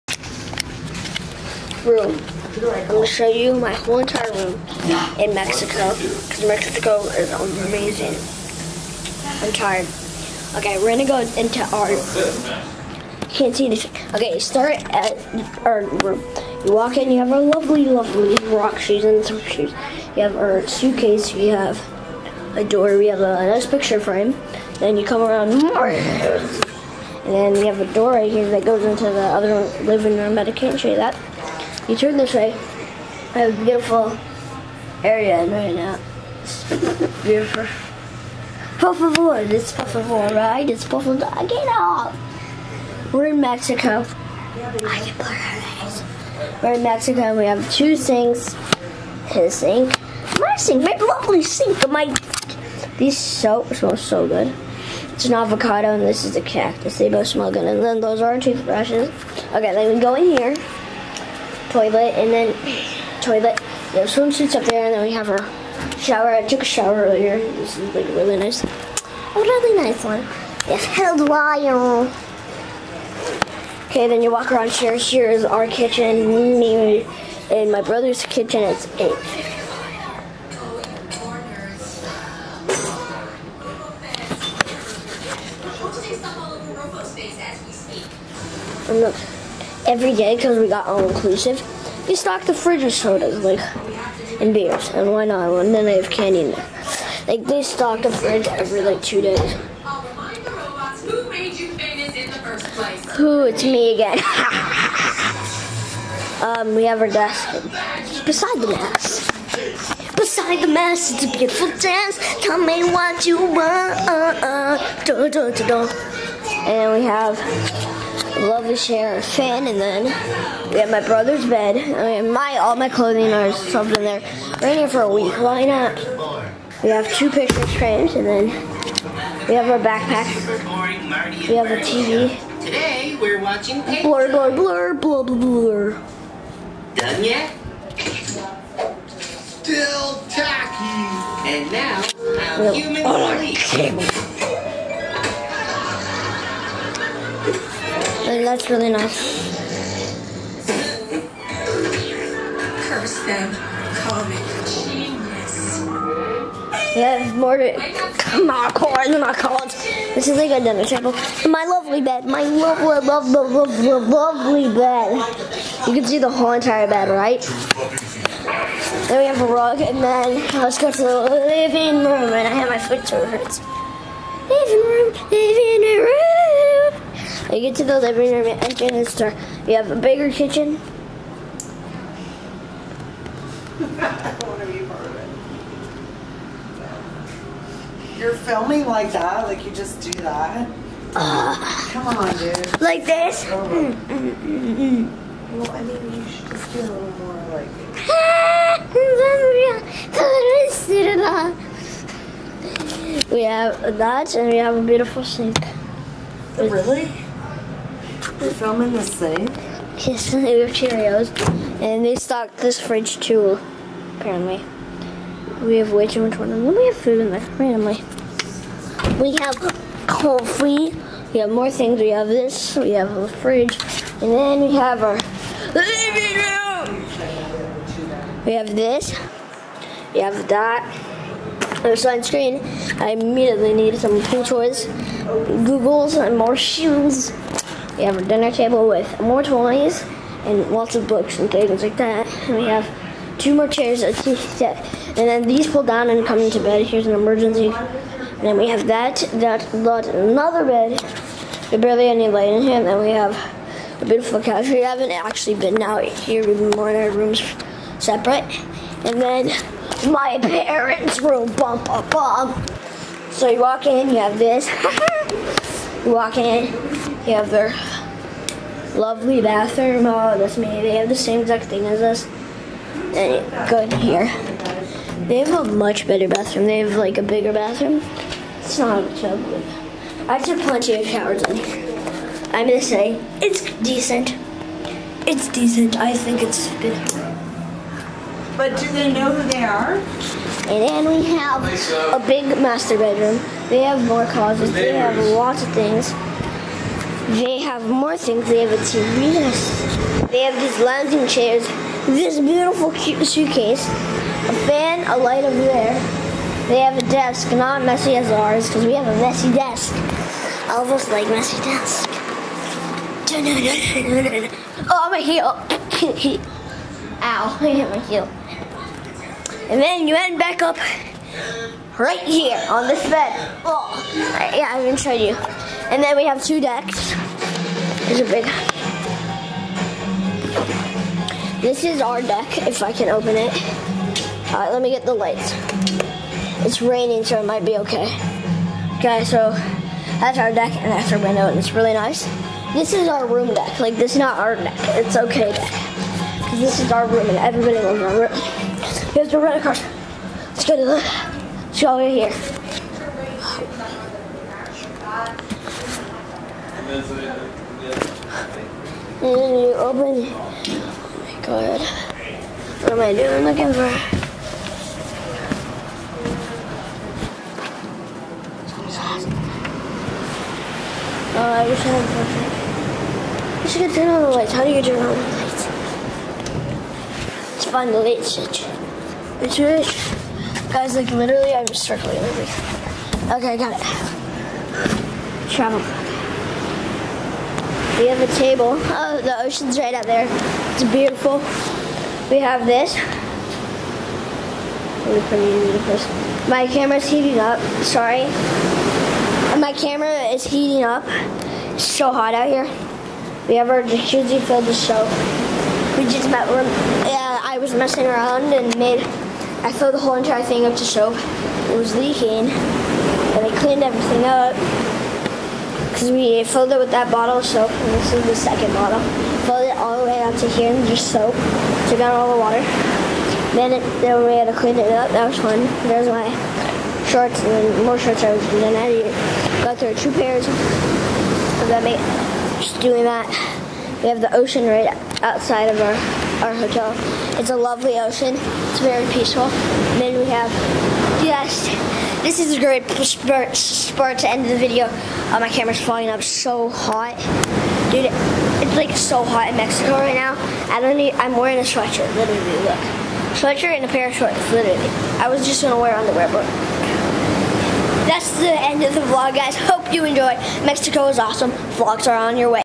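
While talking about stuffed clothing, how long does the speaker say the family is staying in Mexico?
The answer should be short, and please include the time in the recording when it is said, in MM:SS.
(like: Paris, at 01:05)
A week, at 02:05.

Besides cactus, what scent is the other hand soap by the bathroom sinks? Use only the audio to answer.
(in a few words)
Avocado.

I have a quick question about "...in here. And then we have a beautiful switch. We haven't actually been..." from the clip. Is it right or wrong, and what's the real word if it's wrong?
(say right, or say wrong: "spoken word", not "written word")
wrong: "couch", not "switch".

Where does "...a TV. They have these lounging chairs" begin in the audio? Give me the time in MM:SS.
04:58.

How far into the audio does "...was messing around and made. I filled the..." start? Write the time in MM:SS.
06:47.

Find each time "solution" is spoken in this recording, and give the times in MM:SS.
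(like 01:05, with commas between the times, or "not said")
not said.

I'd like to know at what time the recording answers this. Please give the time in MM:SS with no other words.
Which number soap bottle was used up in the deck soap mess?
06:58.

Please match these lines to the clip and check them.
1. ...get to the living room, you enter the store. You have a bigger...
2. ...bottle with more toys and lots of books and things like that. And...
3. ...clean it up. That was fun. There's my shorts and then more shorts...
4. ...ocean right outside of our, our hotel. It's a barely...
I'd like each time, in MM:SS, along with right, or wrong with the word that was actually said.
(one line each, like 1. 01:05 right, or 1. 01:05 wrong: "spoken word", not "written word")
1. 02:57 right
2. 03:58 wrong: "table", not "bottle"
3. 07:04 right
4. 07:14 wrong: "lovely", not "barely".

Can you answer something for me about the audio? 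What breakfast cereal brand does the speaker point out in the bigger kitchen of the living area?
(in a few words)
Cheerios.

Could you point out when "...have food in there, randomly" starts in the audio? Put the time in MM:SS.
03:36.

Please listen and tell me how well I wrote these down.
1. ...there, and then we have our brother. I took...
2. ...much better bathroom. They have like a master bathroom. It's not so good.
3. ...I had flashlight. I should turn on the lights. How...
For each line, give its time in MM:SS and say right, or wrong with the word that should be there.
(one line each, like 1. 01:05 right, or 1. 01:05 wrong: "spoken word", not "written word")
1. 01:04 wrong: "shower", not "brother"
2. 04:35 wrong: "bigger", not "master"
3. 06:11 right.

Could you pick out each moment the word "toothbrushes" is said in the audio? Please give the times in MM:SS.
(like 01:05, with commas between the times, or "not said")
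00:58.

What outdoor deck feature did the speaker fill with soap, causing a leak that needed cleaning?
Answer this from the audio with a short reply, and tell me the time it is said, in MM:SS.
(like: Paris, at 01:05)
Jacuzzi, at 06:43.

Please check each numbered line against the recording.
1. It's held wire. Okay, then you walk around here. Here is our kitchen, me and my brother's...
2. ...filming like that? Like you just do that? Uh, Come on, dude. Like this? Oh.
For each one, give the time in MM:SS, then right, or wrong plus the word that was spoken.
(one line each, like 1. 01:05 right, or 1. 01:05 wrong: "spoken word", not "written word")
1. 01:10 right
2. 03:08 right.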